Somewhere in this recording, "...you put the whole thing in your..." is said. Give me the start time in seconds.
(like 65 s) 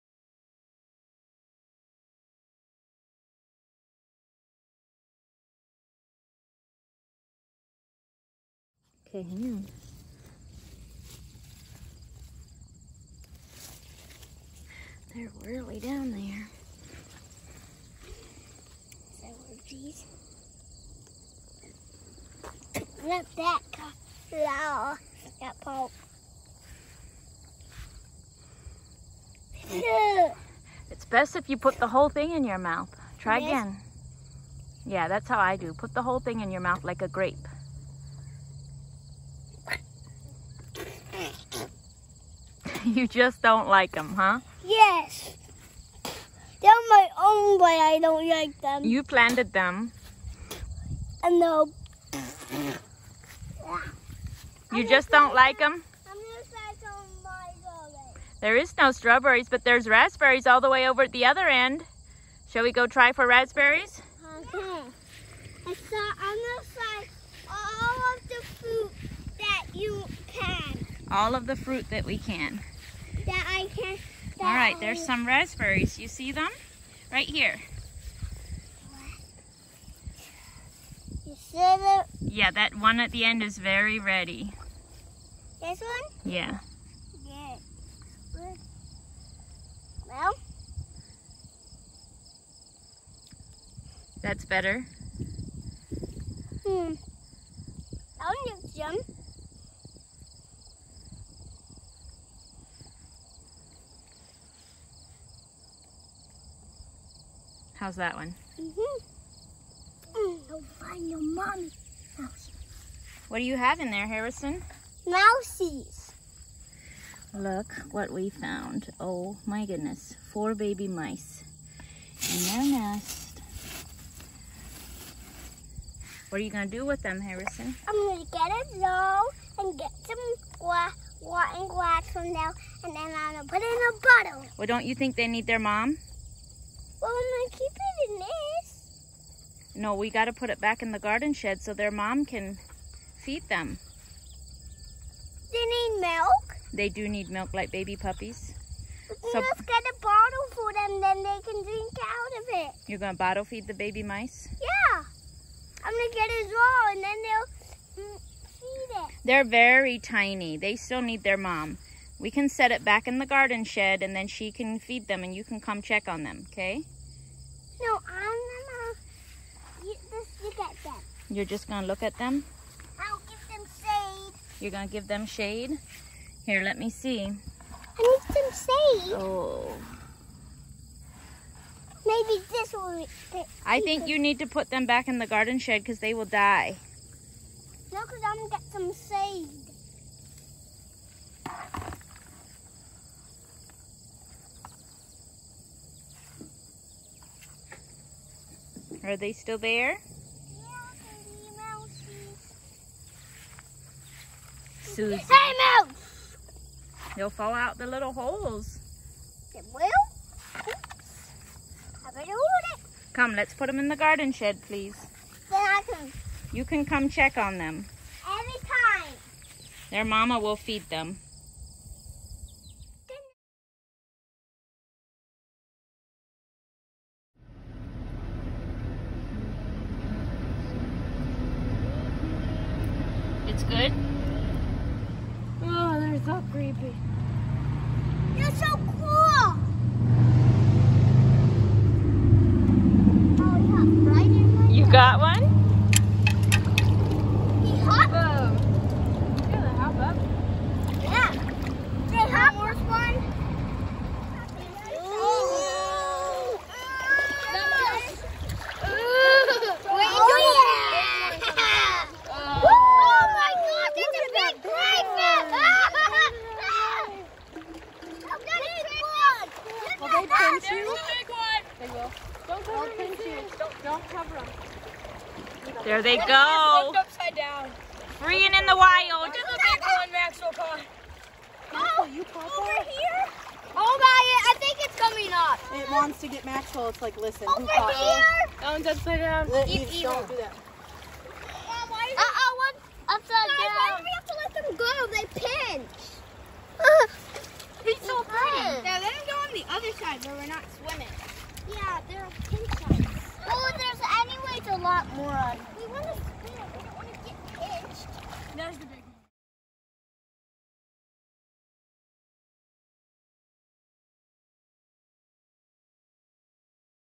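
31 s.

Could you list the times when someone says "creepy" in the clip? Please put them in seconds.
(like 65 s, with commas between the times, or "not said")
236 s.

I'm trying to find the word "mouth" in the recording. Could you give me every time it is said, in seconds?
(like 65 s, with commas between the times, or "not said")
32 s, 36 s.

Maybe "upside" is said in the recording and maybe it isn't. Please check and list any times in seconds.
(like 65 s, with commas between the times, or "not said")
276 s, 288 s, 293 s.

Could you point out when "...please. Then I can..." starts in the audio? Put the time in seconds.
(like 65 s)
214 s.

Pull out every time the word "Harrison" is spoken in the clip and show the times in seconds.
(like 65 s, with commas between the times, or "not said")
114 s, 127 s.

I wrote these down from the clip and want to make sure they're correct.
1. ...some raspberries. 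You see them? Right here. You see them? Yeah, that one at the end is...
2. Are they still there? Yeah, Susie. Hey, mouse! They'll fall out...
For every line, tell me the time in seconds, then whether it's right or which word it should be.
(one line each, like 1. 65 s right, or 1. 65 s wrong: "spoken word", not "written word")
1. 75 s right
2. 199 s right.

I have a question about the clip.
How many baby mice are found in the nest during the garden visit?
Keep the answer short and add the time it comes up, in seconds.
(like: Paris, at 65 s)
4, at 120 s.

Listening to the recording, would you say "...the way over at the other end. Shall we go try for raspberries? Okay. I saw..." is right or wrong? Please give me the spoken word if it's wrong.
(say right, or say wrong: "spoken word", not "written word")
right.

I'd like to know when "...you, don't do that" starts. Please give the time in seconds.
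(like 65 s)
289 s.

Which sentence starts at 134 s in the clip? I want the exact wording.
Well, don't you think they need their mom?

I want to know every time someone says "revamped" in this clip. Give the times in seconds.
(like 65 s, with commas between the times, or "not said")
not said.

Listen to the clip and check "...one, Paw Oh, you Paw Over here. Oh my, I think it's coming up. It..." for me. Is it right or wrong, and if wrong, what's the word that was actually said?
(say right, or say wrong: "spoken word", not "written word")
wrong: "Maxwell", not "Paw".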